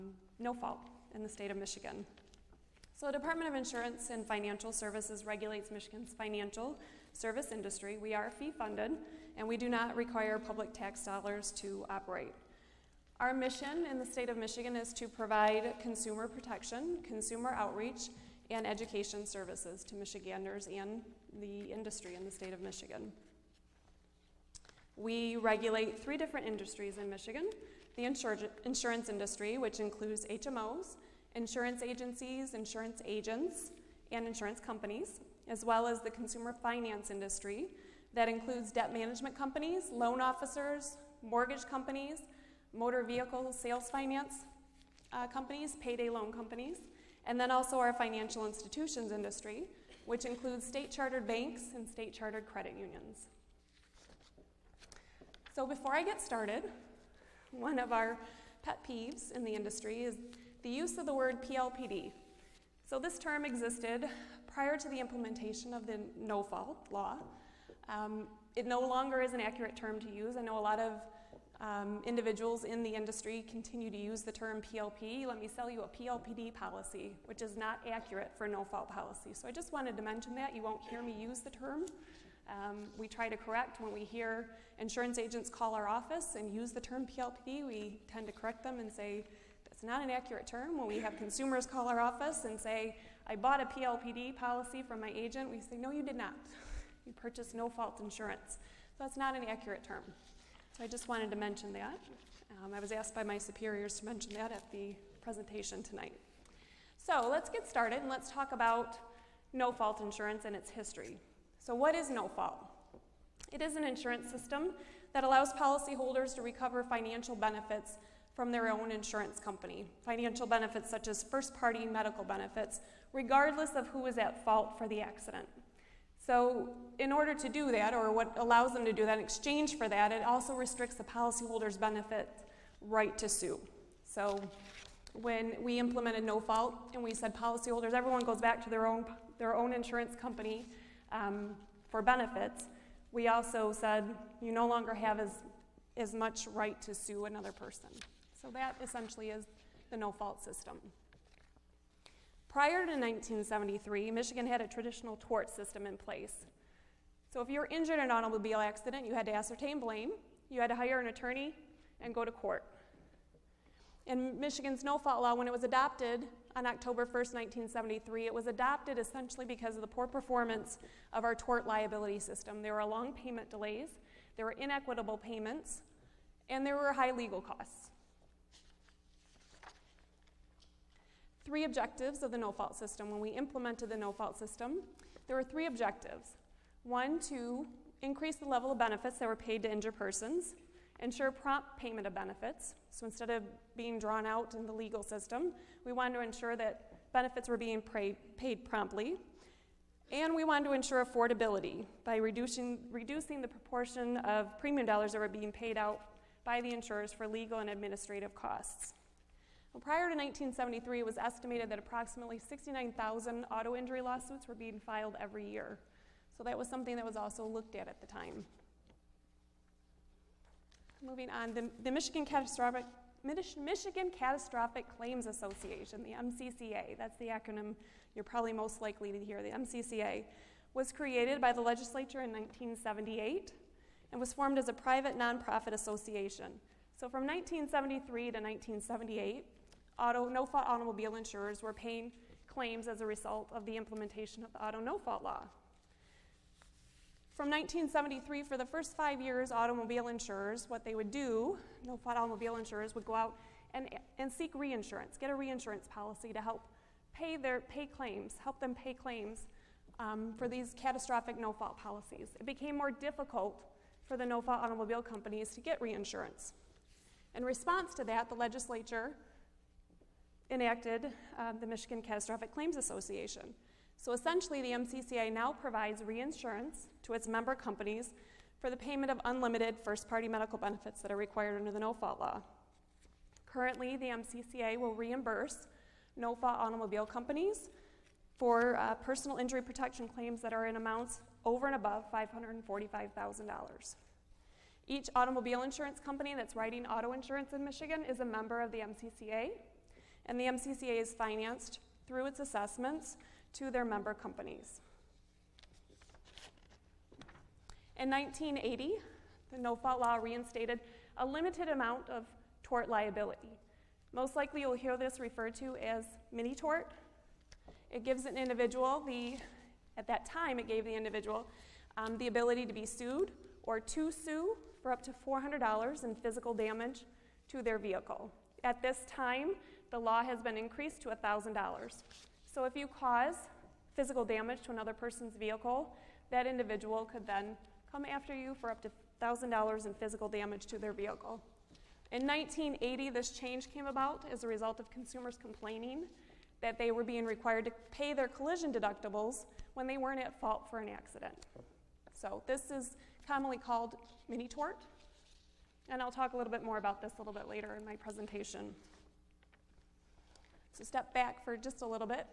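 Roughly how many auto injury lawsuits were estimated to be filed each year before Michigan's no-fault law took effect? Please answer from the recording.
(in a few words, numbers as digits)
69,000.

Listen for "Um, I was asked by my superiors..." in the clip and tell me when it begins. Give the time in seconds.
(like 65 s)
102 s.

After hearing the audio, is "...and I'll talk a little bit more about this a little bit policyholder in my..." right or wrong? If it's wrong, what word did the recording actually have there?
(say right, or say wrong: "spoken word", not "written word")
wrong: "later", not "policyholder".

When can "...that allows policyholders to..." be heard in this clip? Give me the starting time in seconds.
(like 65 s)
115 s.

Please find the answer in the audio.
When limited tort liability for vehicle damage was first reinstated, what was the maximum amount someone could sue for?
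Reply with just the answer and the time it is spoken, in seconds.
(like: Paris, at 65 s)
$400, at 325 s.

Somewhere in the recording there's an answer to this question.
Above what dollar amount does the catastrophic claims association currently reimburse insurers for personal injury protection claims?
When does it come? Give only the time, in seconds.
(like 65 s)
292 s.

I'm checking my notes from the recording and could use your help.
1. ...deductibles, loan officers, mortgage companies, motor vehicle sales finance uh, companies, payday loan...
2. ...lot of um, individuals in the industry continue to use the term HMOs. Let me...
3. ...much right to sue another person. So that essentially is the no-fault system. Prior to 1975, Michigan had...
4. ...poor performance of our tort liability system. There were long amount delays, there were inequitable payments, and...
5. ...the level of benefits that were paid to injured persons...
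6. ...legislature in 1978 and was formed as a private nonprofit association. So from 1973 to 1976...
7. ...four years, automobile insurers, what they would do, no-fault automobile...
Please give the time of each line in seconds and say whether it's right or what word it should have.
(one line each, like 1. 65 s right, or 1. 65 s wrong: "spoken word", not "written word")
1. 39 s wrong: "companies", not "deductibles"
2. 70 s wrong: "PLP", not "HMOs"
3. 146 s wrong: "1973", not "1975"
4. 169 s wrong: "payment", not "amount"
5. 188 s right
6. 231 s wrong: "1978", not "1976"
7. 248 s wrong: "five", not "four".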